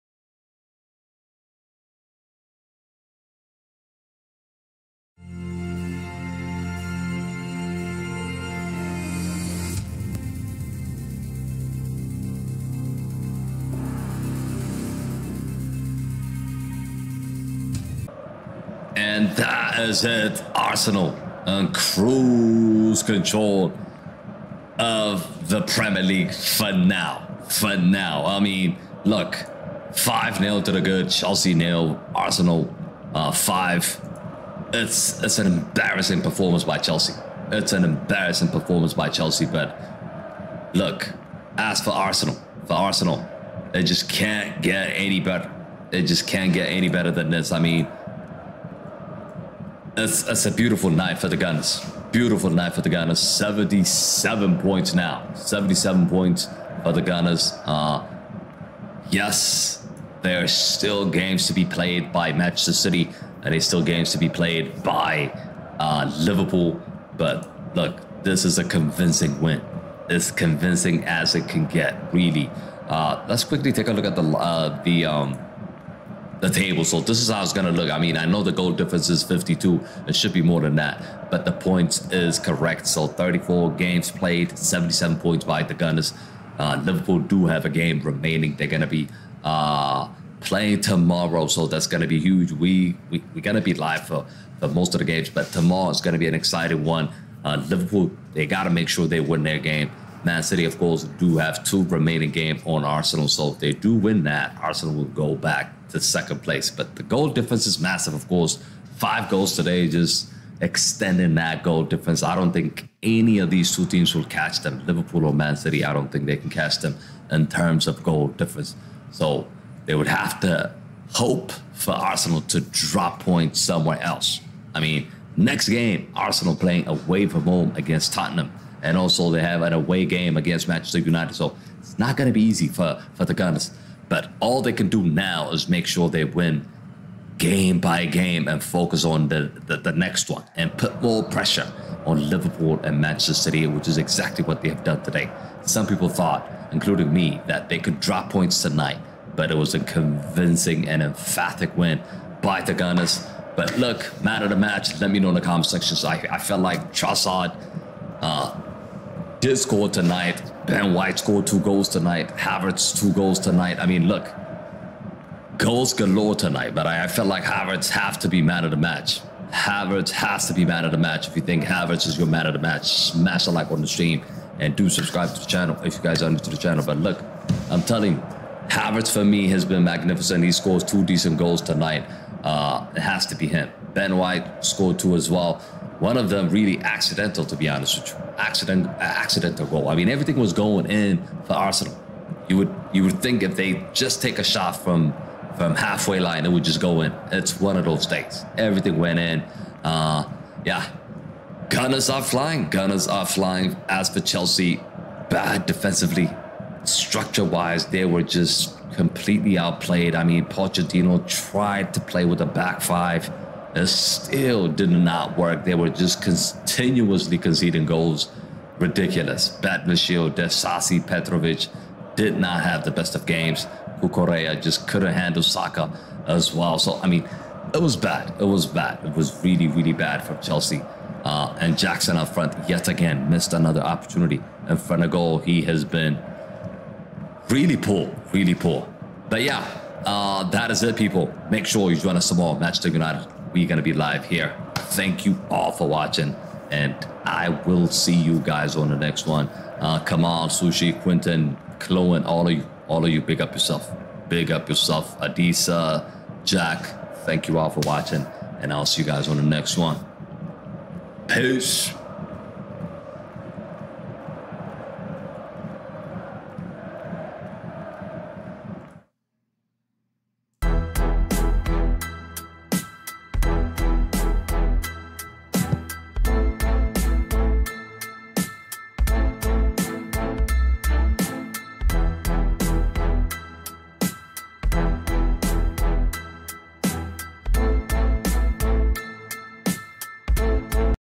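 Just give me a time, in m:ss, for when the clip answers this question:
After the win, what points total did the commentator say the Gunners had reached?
0:53.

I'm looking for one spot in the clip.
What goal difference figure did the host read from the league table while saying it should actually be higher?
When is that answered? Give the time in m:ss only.
1:18.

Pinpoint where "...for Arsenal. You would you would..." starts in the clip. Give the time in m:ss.
3:11.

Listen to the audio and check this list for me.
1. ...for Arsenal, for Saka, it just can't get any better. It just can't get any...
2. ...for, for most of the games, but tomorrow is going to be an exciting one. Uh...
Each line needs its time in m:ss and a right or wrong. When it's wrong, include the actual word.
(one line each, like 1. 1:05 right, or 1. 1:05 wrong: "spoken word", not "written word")
1. 0:41 wrong: "Arsenal", not "Saka"
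2. 1:34 right.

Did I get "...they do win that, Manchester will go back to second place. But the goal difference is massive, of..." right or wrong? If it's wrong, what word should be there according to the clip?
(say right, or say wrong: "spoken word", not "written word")
wrong: "Arsenal", not "Manchester".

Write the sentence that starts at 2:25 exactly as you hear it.
Some people thought, including me, that they could drop points tonight, but it was a convincing and emphatic win by the Gunners.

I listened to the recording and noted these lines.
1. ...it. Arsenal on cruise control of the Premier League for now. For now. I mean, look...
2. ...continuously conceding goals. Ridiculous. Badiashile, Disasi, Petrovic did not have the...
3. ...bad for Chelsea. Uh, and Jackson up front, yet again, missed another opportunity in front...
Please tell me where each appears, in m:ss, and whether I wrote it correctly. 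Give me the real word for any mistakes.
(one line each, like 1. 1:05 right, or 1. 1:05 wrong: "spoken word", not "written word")
1. 0:20 right
2. 3:36 right
3. 3:49 right.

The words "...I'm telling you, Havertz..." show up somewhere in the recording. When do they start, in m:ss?
2:57.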